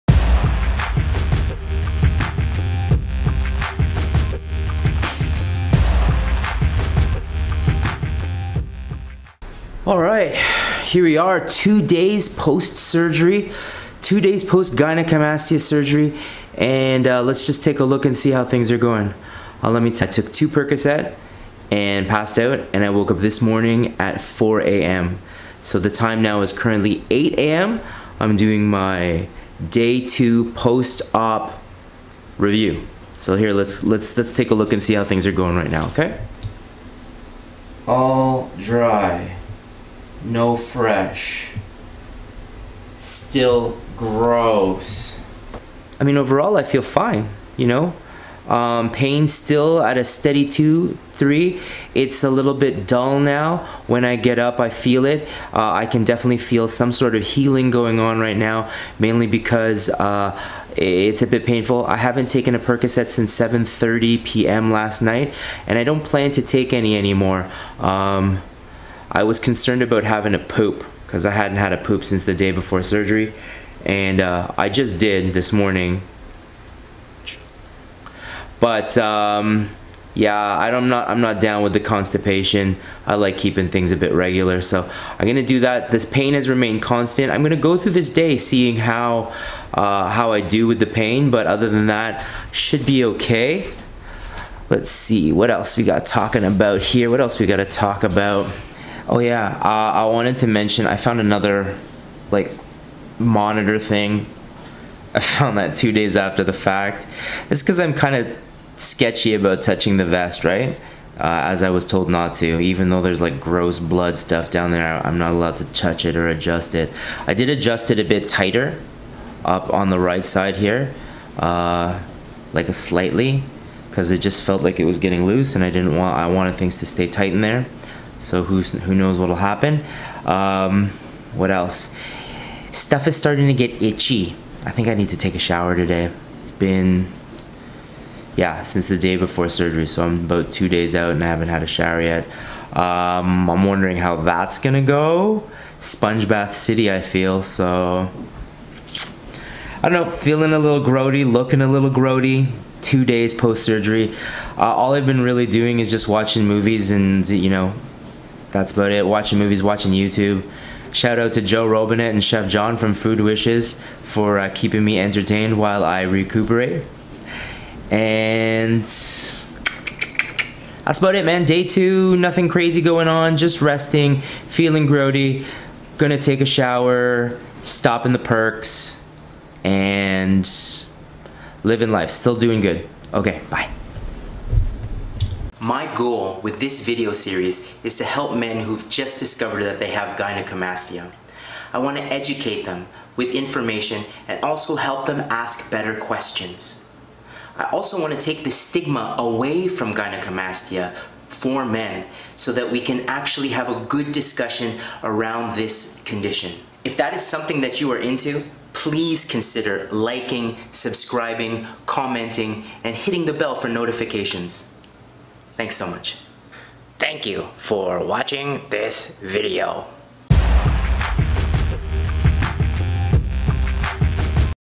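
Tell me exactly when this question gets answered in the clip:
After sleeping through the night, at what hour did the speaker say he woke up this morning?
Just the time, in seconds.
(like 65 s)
24 s.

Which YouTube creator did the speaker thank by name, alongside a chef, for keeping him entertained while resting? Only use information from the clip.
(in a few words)
Joe Robinet.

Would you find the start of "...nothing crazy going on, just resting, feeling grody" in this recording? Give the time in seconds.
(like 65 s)
172 s.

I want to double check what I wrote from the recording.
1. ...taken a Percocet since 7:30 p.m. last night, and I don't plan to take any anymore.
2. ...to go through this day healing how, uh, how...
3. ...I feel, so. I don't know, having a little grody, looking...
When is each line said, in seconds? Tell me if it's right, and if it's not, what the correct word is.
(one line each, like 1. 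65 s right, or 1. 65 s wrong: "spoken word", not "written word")
1. 62 s right
2. 87 s wrong: "seeing", not "healing"
3. 146 s wrong: "feeling", not "having".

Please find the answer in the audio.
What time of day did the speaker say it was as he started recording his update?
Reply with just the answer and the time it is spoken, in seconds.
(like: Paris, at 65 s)
8 a.m., at 27 s.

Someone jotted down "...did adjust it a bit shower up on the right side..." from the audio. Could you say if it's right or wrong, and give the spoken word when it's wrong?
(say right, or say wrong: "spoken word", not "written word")
wrong: "tighter", not "shower".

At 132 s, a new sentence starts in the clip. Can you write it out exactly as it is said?
Stuff is starting to get itchy.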